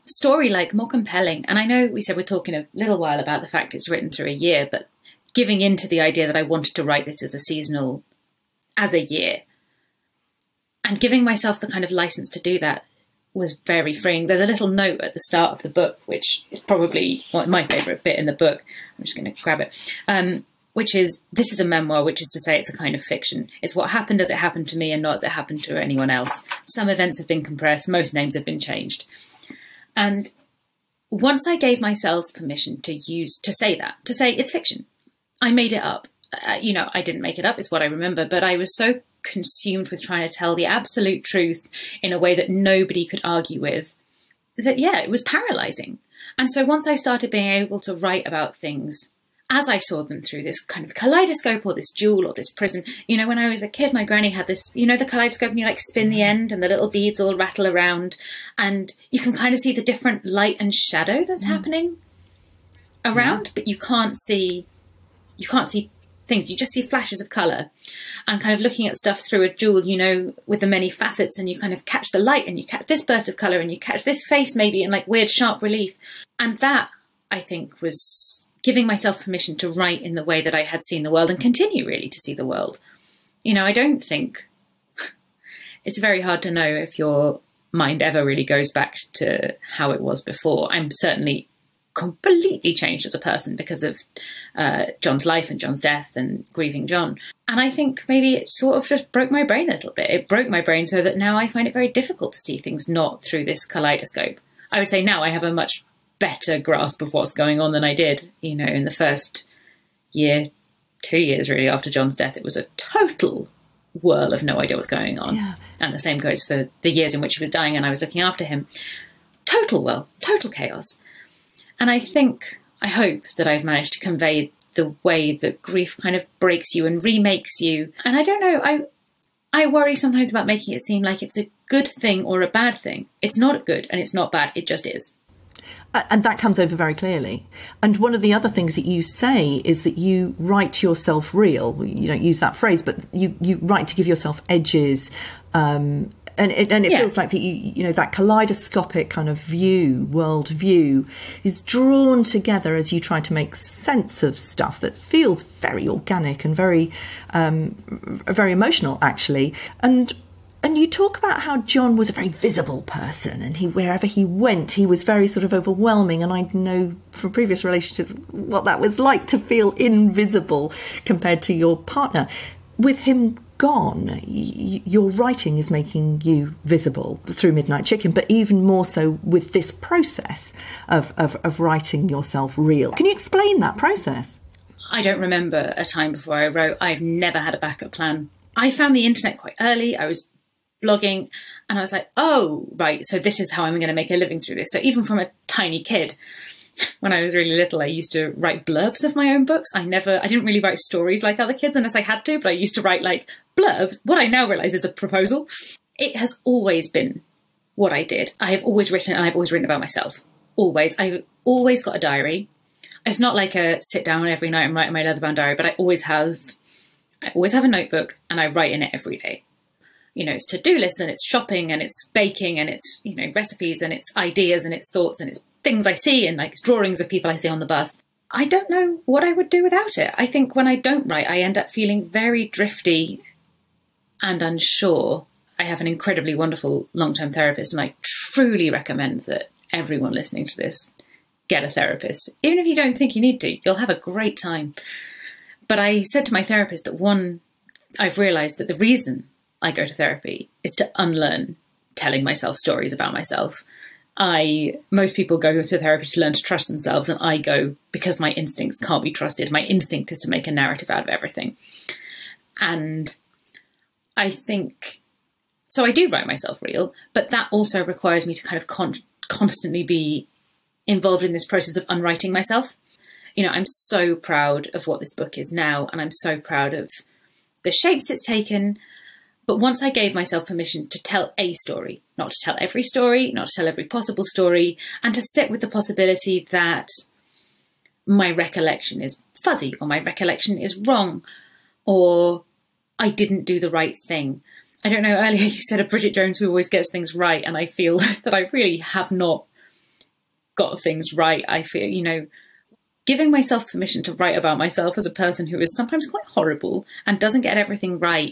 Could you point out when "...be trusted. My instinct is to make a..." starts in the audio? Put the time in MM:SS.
04:19.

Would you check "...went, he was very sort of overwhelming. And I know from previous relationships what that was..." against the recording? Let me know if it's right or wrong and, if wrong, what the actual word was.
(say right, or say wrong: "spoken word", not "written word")
right.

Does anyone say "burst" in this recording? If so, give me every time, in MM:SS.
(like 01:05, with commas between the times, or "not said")
01:13.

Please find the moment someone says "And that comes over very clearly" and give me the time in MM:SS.
02:15.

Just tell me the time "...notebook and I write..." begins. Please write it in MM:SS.
03:37.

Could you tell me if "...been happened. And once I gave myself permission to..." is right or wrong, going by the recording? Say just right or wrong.
wrong.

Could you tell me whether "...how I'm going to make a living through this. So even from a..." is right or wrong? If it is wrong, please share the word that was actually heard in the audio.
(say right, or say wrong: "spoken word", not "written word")
right.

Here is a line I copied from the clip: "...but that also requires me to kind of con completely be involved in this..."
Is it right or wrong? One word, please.
wrong.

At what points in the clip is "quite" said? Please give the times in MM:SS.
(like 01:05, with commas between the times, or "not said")
03:09, 05:06.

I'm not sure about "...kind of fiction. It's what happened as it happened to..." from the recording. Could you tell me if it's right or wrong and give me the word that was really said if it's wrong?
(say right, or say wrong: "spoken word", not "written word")
right.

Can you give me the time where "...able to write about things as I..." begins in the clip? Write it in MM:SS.
00:47.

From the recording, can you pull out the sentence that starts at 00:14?
There's a little note at the start of the book, which is probably my favourite bit in the book.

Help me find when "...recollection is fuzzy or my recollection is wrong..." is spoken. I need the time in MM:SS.
04:48.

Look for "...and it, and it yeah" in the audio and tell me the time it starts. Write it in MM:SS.
02:26.